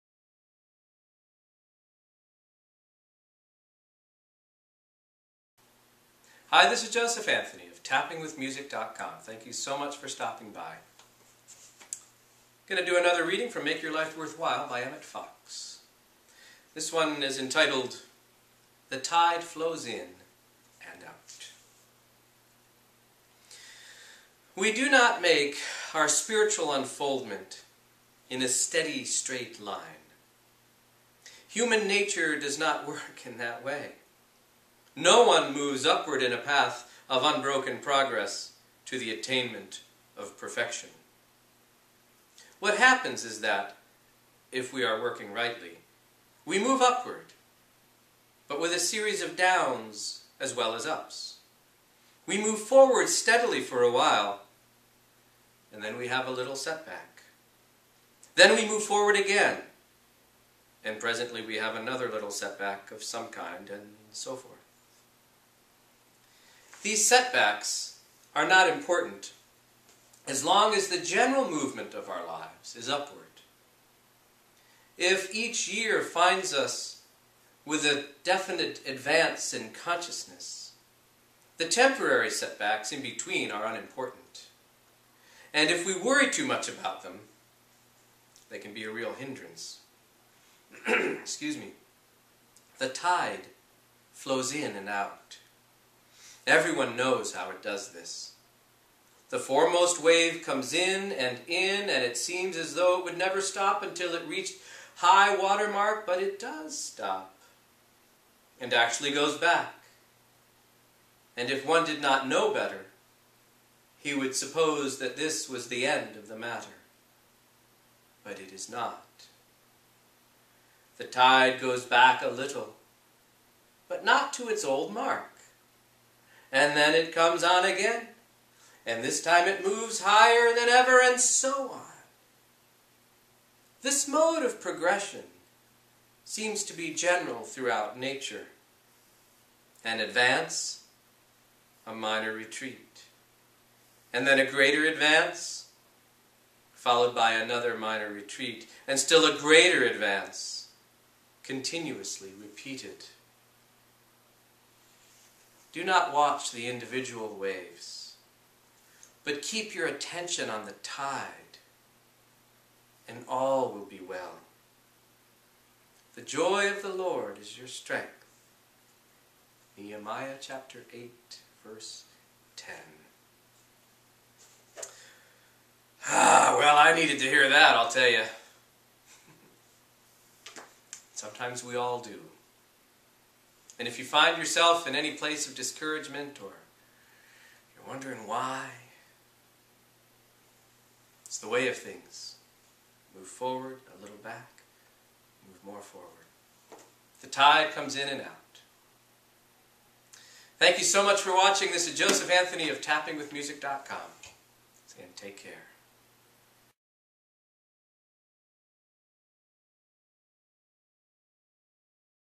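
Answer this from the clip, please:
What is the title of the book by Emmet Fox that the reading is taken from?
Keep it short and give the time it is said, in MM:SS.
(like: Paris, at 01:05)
Make Your Life Worthwhile, at 00:13.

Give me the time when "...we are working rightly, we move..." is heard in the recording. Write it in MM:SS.
00:44.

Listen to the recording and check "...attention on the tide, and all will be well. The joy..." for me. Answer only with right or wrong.
right.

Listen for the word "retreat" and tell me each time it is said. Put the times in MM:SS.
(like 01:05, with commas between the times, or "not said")
02:22, 02:28.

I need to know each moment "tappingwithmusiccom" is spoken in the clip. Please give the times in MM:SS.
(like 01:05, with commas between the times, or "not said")
00:07, 03:22.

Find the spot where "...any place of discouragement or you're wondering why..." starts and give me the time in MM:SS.
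03:04.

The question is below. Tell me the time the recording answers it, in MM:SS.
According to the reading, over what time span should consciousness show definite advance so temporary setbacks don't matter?
01:15.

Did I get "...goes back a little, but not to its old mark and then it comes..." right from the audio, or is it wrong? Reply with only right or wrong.
right.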